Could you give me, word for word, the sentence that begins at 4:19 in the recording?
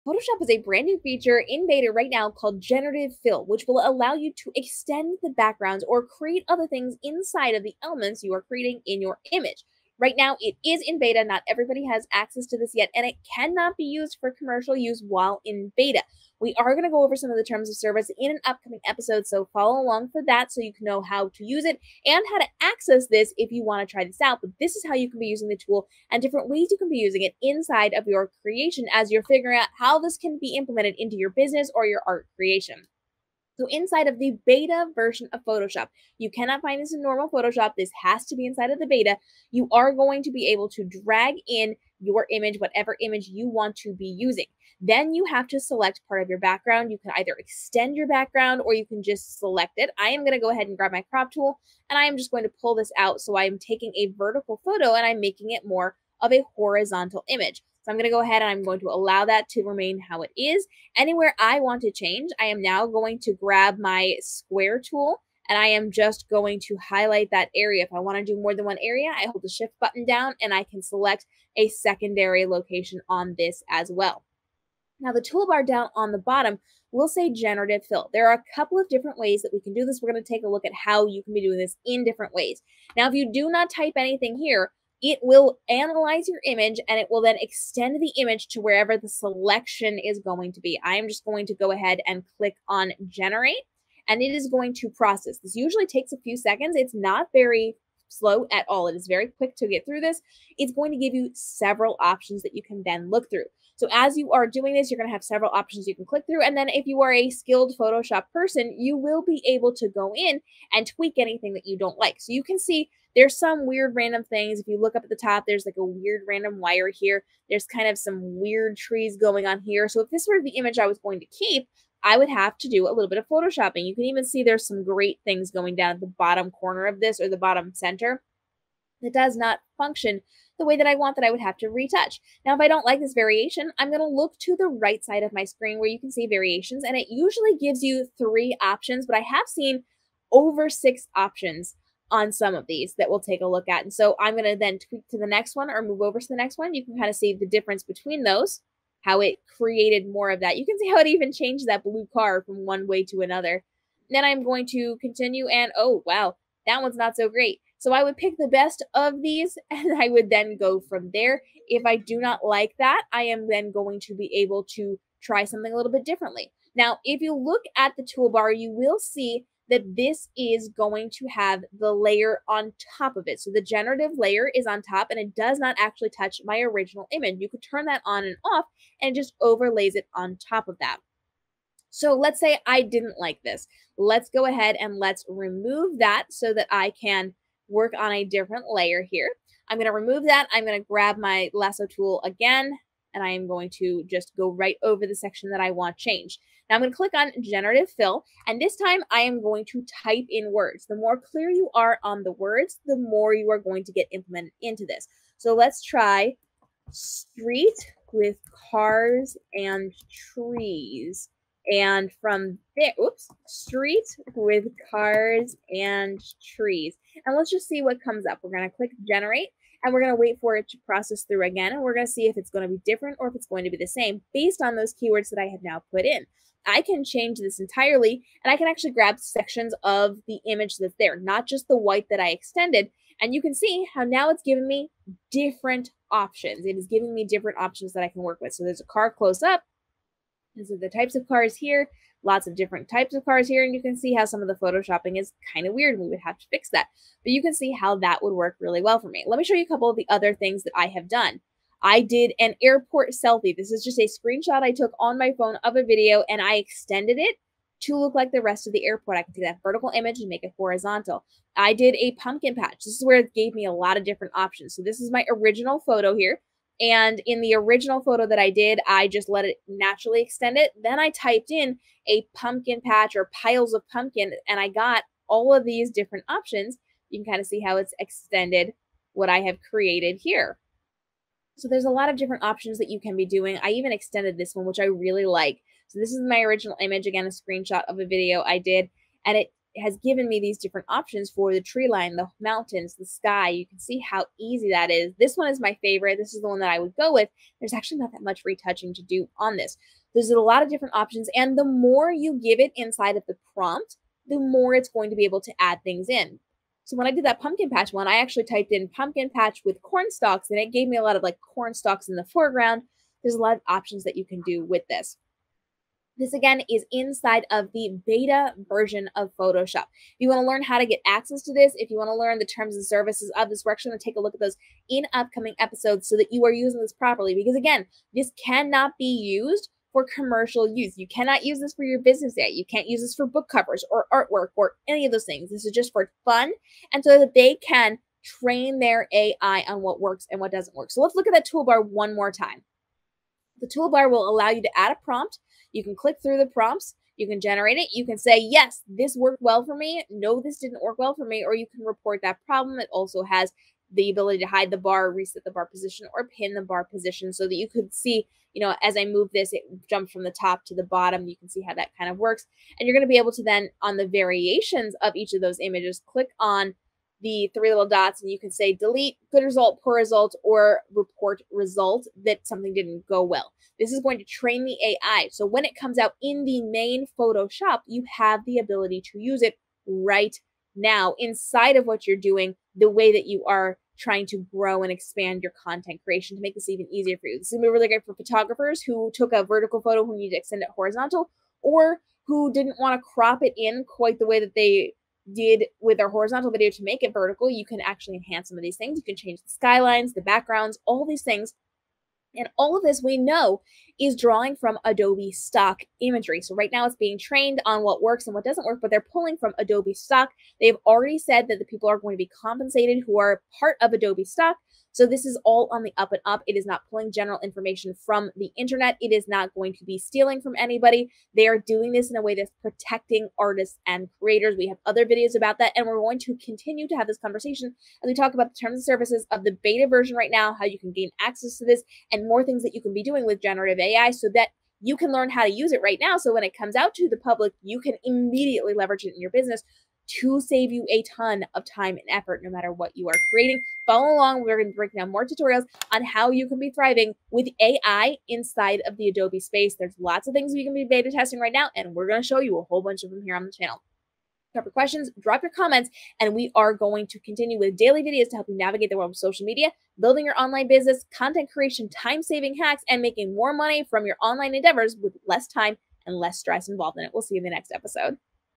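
I can take that vertical image and make it horizontal.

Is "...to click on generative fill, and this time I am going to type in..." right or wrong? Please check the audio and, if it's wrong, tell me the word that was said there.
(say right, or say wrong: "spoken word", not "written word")
right.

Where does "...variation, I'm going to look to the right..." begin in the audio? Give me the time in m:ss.
2:13.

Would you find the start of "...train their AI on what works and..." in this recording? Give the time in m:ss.
5:38.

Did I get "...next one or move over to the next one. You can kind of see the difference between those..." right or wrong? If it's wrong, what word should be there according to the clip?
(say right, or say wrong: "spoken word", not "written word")
right.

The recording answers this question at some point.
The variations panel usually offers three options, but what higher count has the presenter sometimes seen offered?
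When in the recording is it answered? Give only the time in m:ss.
2:20.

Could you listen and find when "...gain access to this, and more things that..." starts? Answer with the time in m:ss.
7:10.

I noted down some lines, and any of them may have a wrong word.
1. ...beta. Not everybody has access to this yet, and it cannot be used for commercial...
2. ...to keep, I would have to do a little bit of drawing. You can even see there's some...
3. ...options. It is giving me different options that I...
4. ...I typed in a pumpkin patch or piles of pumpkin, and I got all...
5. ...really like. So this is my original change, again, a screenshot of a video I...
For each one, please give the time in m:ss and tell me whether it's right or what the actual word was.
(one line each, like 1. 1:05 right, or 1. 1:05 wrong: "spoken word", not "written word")
1. 0:10 right
2. 2:01 wrong: "photoshopping", not "drawing"
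3. 3:56 right
4. 4:30 right
5. 4:44 wrong: "image", not "change".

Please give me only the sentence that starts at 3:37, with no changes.
And let's just see what comes up.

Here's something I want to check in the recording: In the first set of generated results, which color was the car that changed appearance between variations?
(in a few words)
Blue.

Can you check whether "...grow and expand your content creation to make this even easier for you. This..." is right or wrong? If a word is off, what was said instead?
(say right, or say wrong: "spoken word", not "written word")
right.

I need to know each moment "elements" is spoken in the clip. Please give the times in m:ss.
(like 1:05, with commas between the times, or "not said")
0:07.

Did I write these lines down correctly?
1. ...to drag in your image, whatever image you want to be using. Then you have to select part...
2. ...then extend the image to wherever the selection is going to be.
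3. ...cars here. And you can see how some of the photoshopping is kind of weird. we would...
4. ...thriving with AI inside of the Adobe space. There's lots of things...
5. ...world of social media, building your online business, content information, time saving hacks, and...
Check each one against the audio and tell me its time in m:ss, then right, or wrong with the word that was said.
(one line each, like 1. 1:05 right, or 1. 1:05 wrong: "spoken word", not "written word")
1. 0:40 right
2. 1:27 right
3. 4:03 right
4. 7:26 right
5. 7:38 wrong: "creation", not "information".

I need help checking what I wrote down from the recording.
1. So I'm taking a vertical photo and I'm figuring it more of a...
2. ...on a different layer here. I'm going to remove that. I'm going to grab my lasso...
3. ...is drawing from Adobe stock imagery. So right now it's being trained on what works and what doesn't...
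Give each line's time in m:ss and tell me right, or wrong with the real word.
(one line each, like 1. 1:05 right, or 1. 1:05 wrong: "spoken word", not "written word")
1. 0:53 wrong: "making", not "figuring"
2. 3:07 right
3. 6:43 right.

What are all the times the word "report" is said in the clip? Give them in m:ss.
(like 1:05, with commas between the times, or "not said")
5:51, 6:10.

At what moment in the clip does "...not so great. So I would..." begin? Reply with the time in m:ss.
2:36.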